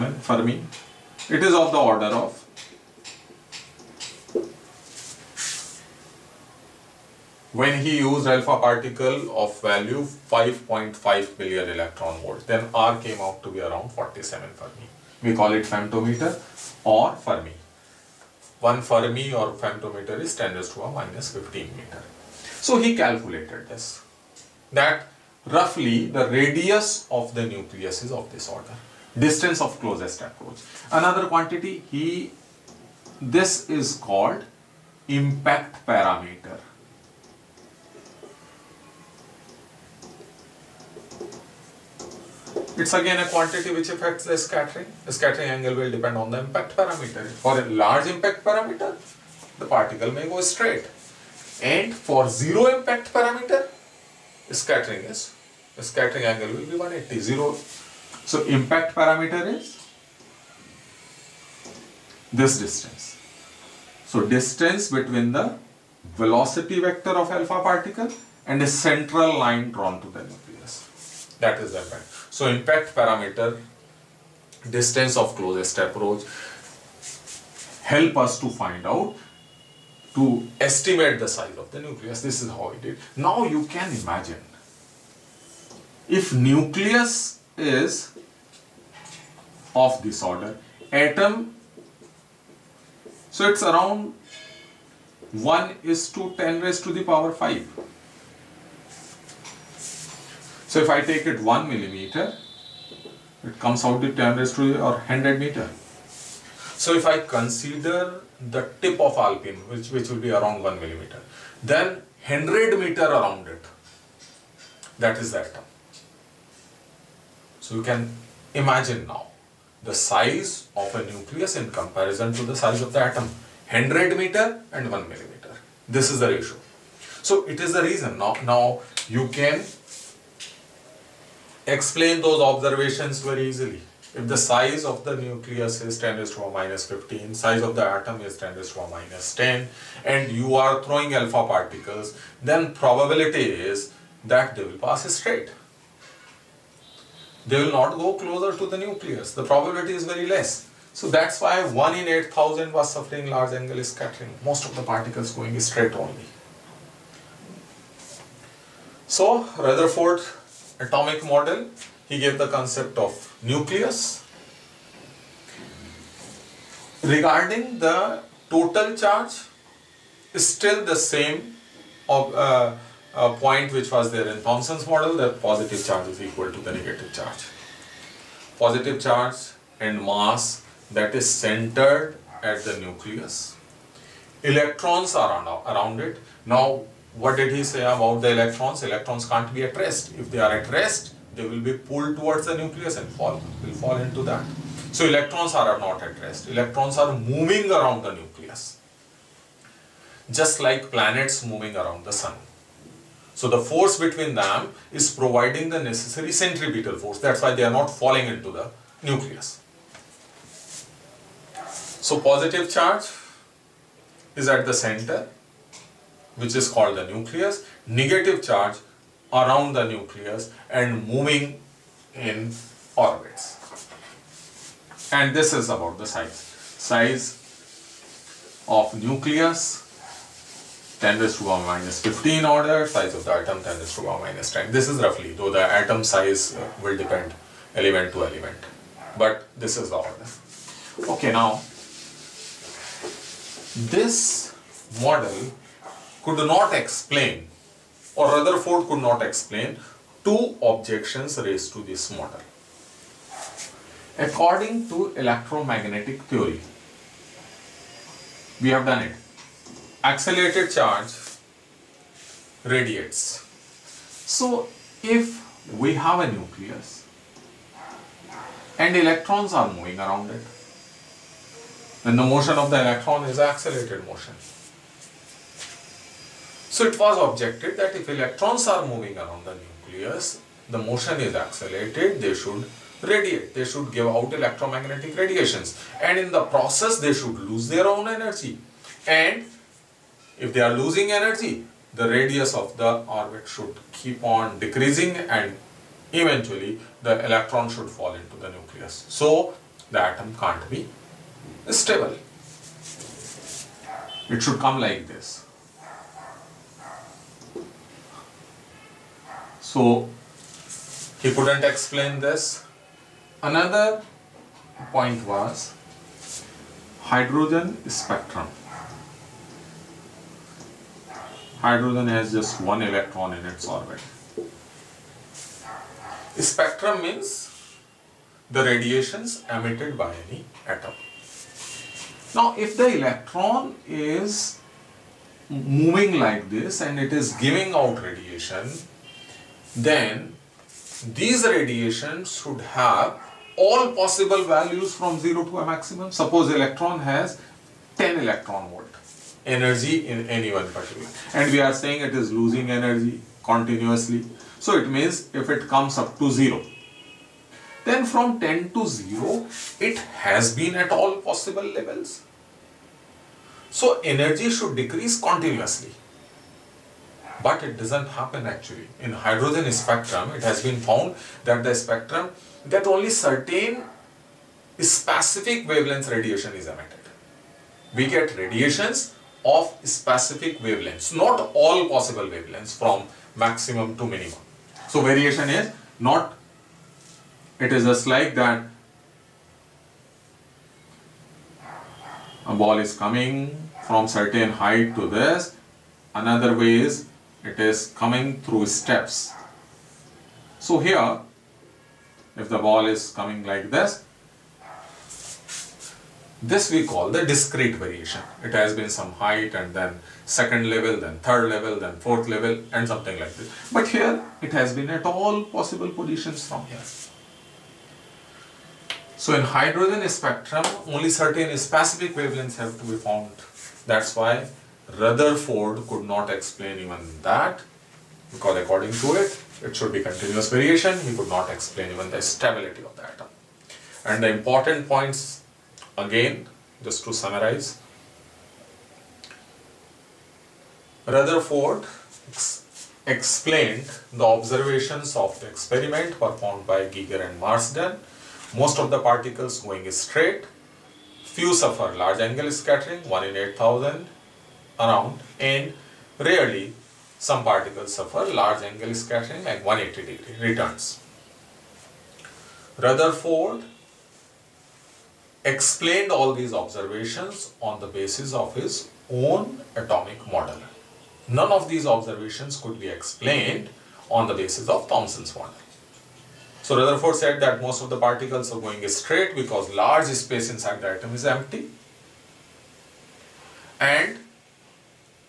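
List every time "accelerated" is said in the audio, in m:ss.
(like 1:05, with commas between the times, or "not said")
4:20, 4:33, 4:41.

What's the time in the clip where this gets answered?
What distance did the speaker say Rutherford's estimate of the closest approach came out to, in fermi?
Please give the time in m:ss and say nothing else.
0:13.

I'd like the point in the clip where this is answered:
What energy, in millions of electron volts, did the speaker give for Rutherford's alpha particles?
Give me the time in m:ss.
0:10.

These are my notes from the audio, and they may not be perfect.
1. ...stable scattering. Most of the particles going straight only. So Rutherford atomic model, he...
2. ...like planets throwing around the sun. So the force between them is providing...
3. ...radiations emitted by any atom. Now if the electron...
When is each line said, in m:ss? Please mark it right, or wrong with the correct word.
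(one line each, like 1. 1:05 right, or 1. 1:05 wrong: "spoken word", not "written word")
1. 2:33 wrong: "angle", not "stable"
2. 3:20 wrong: "moving", not "throwing"
3. 5:28 right.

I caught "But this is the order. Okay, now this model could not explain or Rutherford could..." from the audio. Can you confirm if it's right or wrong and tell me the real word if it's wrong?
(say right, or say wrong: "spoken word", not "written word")
right.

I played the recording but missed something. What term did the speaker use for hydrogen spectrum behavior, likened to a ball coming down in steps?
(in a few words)
discrete variation.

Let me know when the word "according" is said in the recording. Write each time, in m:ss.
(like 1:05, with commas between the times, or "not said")
4:14, 7:08.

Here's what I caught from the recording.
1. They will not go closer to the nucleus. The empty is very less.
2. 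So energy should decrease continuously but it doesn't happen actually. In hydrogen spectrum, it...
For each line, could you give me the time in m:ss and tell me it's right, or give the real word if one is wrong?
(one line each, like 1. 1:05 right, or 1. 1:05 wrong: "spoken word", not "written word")
1. 2:27 wrong: "probability", not "empty"
2. 6:03 right.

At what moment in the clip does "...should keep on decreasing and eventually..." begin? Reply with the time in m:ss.
4:53.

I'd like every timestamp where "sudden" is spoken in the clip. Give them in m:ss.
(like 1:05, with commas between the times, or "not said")
not said.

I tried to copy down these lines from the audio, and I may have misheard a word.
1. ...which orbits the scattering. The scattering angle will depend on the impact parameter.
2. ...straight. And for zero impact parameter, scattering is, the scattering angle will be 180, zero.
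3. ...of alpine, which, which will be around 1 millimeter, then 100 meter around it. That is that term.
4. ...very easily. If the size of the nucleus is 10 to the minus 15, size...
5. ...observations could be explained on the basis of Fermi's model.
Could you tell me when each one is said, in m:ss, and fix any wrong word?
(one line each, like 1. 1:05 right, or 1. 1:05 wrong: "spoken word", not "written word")
1. 0:43 wrong: "affects", not "orbits"
2. 0:50 right
3. 1:49 right
4. 2:13 right
5. 7:51 wrong: "Thomson", not "Fermi".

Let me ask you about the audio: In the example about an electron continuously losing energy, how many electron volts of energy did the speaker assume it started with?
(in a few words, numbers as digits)
10 electron volts.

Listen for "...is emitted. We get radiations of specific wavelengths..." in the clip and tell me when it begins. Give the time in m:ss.
6:16.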